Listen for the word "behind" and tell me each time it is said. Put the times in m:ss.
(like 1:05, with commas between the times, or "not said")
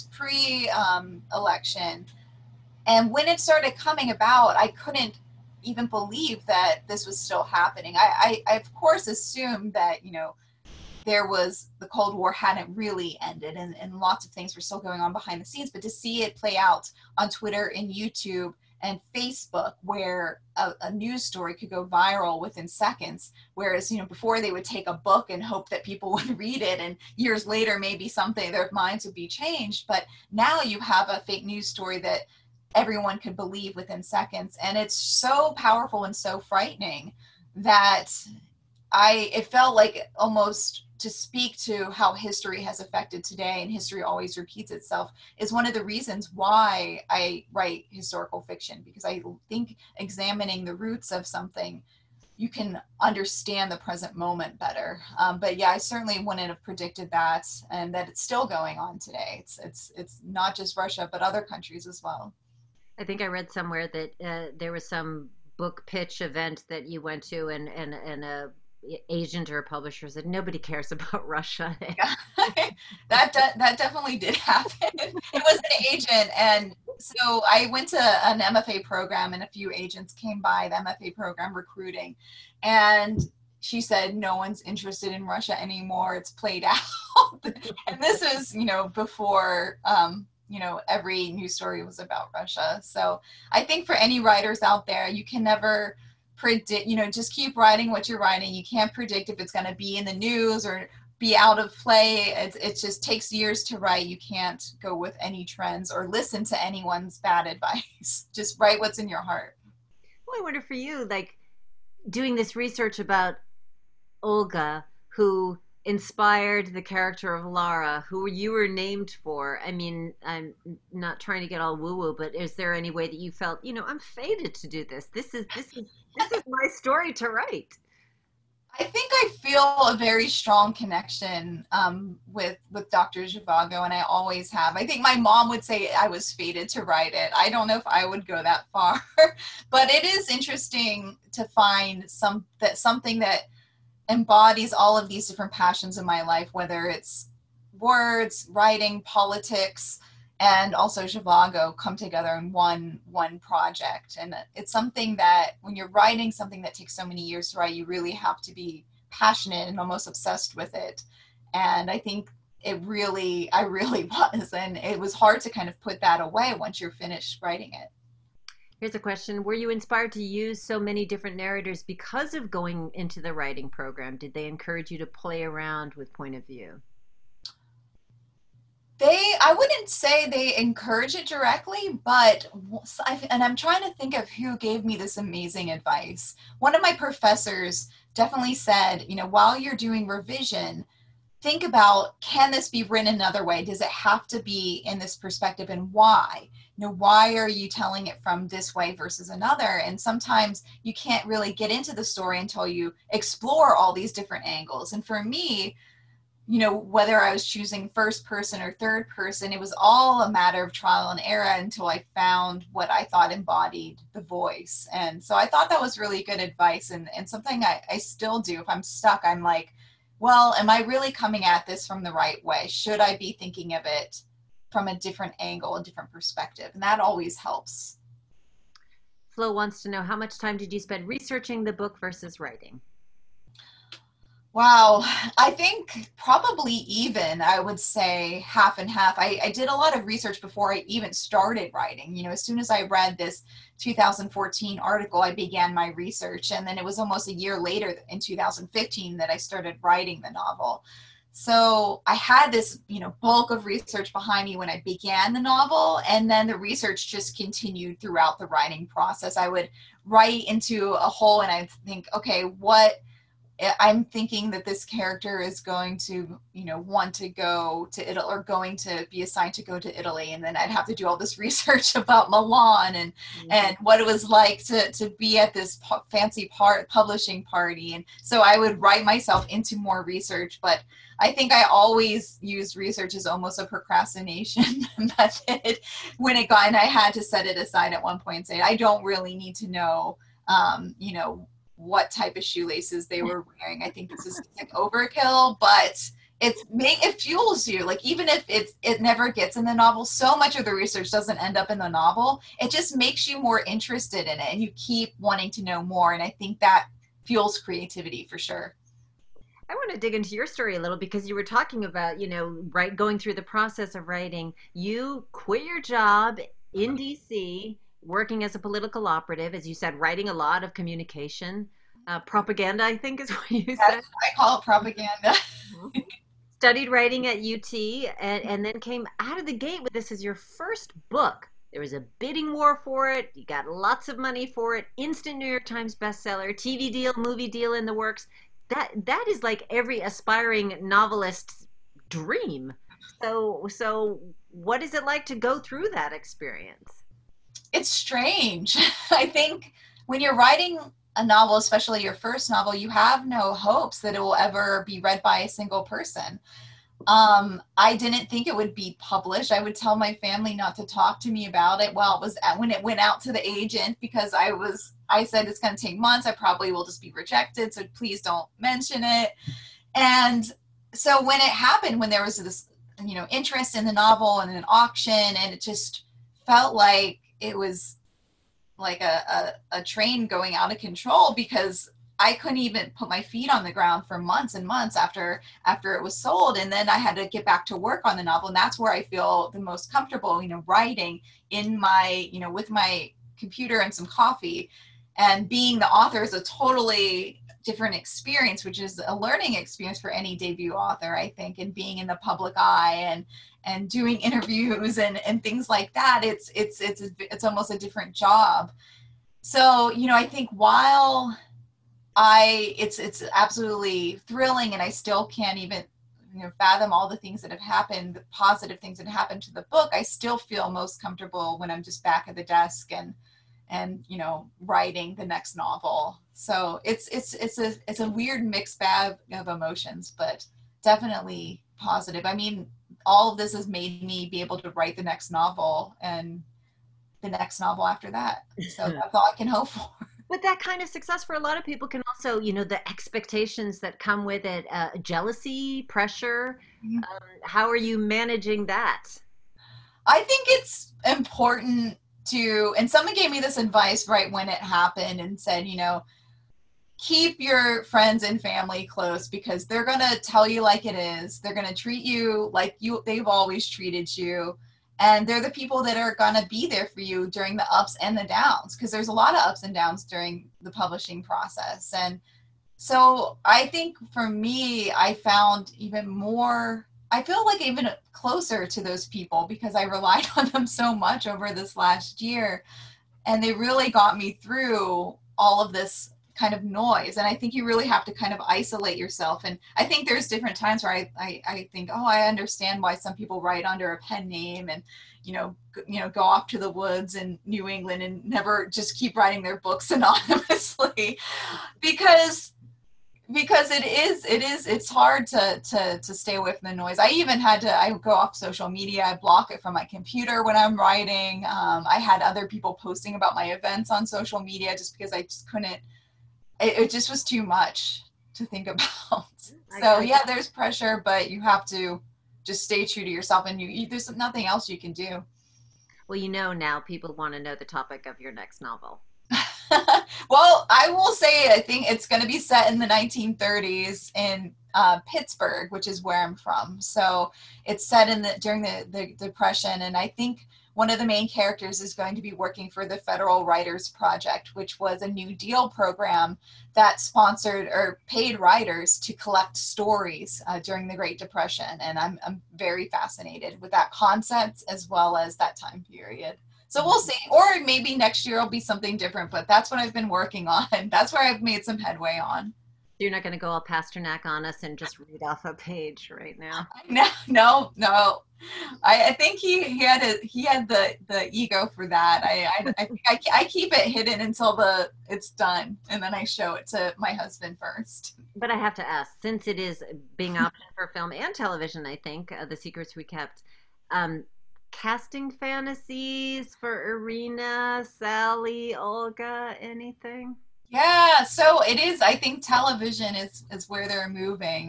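0:15, 4:14.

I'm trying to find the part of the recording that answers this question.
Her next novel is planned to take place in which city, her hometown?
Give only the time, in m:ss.
8:55.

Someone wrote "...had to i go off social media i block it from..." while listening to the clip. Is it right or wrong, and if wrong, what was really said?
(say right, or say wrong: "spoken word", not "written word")
right.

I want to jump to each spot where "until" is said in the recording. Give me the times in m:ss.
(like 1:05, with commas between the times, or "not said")
3:22, 3:31, 9:34.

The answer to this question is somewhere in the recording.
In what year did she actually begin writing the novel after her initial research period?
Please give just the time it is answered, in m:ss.
4:08.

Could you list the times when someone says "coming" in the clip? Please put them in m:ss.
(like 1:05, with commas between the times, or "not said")
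0:03, 3:41.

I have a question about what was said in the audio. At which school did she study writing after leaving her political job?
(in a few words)
UT.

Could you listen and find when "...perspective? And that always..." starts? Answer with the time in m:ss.
3:46.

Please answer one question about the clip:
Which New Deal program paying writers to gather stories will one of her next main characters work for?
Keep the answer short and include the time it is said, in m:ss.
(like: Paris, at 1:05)
Federal Writers Project, at 9:02.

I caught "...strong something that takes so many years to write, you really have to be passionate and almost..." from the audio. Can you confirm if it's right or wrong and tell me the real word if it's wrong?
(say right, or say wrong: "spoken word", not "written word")
wrong: "writing", not "strong".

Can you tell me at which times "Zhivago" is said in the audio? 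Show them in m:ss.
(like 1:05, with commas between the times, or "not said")
2:13, 2:31.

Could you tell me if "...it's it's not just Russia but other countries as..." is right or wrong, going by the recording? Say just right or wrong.
right.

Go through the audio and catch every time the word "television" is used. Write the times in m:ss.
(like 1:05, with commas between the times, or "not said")
9:41, 9:52.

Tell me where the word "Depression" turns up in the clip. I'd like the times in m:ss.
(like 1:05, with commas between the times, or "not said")
8:59, 9:11.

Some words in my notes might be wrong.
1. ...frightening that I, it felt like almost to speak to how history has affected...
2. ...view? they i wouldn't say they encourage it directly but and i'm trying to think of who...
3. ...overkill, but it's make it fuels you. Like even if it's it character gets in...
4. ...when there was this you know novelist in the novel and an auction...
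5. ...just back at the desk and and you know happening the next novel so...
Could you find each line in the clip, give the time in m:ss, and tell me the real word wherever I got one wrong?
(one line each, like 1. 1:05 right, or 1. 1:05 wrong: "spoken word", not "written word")
1. 0:36 right
2. 2:56 right
3. 4:54 wrong: "never", not "character"
4. 6:11 wrong: "interest", not "novelist"
5. 7:01 wrong: "writing", not "happening".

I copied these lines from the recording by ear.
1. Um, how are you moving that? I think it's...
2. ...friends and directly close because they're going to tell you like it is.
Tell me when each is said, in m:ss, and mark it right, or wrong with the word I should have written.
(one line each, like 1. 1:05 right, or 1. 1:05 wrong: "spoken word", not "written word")
1. 7:27 wrong: "managing", not "moving"
2. 7:37 wrong: "family", not "directly".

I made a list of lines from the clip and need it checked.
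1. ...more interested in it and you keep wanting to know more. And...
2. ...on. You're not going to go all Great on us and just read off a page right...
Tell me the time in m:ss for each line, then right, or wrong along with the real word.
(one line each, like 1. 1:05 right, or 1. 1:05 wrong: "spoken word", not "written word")
1. 5:03 right
2. 9:22 wrong: "Pasternak", not "Great".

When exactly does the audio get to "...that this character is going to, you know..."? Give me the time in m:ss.
4:24.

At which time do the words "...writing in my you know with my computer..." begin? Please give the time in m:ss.
6:30.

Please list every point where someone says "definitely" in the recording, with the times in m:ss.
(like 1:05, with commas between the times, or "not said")
1:13, 3:08, 7:10.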